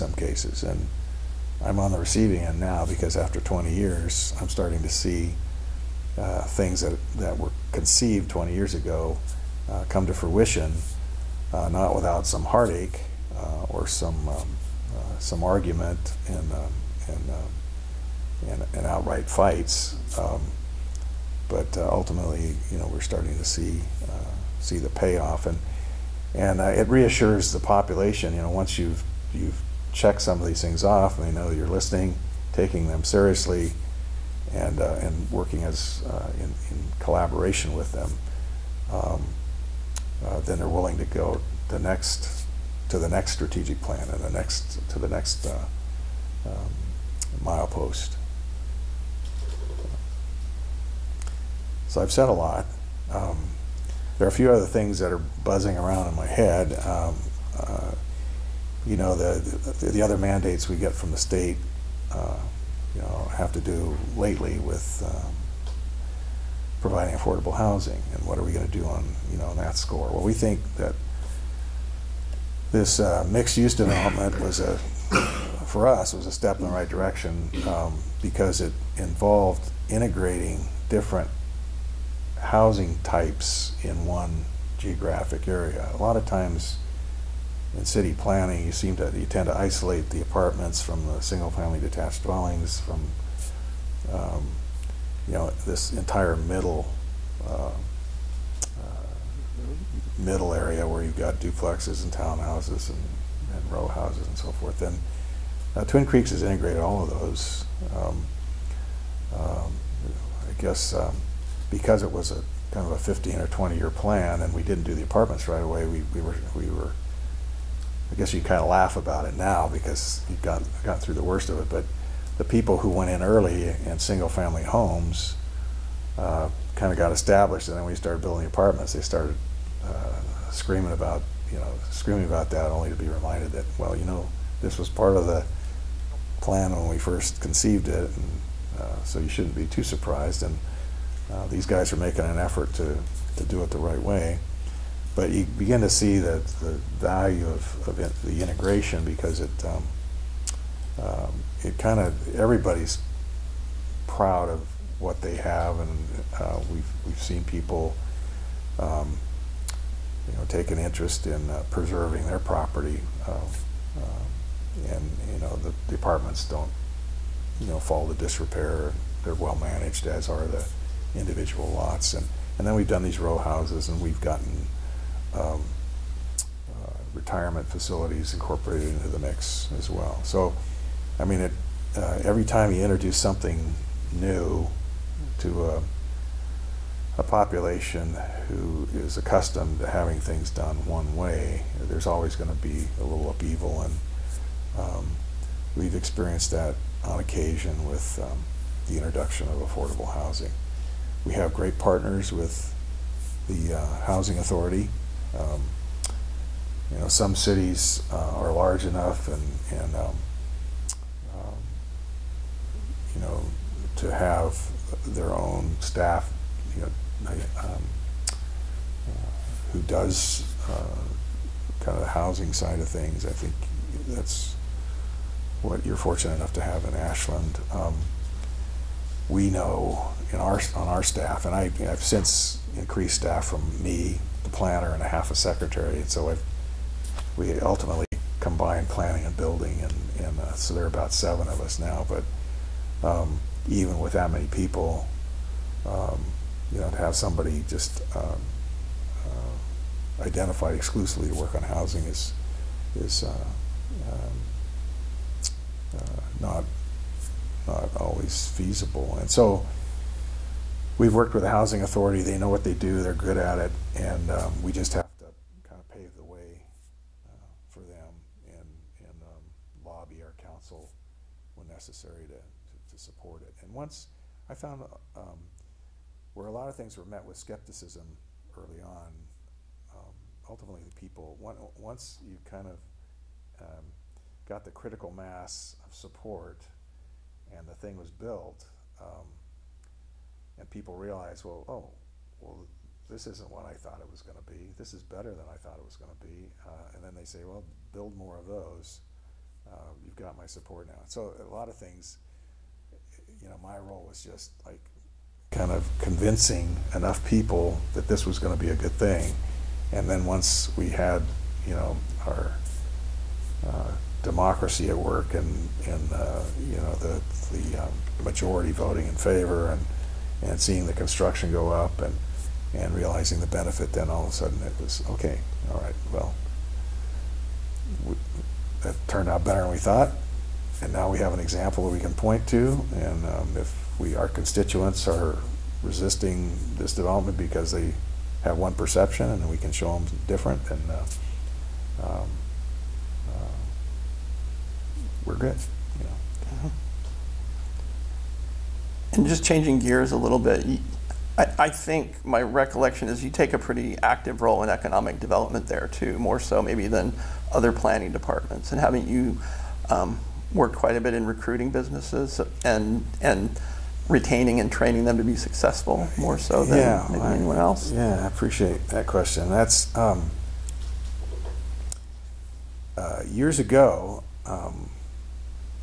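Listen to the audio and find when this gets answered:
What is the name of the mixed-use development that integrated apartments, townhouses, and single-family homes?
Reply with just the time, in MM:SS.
01:45.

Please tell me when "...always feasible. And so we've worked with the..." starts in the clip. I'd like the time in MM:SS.
04:17.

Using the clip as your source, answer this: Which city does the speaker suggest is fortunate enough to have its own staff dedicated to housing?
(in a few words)
Ashland.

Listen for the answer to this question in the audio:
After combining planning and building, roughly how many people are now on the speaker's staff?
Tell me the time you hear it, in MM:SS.
04:01.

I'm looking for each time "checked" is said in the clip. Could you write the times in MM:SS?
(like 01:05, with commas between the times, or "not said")
00:29.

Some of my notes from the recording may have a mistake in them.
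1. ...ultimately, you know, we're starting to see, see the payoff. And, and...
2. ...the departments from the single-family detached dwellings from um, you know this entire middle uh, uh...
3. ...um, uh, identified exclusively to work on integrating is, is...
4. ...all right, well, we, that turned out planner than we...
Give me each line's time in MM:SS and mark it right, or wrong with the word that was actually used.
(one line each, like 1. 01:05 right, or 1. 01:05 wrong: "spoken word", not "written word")
1. 00:21 right
2. 01:30 wrong: "apartments", not "departments"
3. 04:08 wrong: "housing", not "integrating"
4. 05:25 wrong: "better", not "planner".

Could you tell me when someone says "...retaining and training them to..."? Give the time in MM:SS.
06:04.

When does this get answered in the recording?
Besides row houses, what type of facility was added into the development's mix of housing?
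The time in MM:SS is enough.
02:57.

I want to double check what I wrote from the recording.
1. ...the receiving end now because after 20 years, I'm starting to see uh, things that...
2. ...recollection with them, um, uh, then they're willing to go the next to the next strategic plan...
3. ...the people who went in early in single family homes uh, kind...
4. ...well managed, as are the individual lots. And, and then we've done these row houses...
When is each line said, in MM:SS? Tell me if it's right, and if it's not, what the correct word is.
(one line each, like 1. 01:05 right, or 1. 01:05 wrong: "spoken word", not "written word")
1. 00:01 right
2. 00:36 wrong: "collaboration", not "recollection"
3. 02:02 right
4. 02:49 right.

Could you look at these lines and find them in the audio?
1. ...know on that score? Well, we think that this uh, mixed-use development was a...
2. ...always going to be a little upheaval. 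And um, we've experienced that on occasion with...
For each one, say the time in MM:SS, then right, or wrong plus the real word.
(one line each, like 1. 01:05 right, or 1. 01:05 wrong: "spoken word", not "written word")
1. 01:09 right
2. 03:12 right.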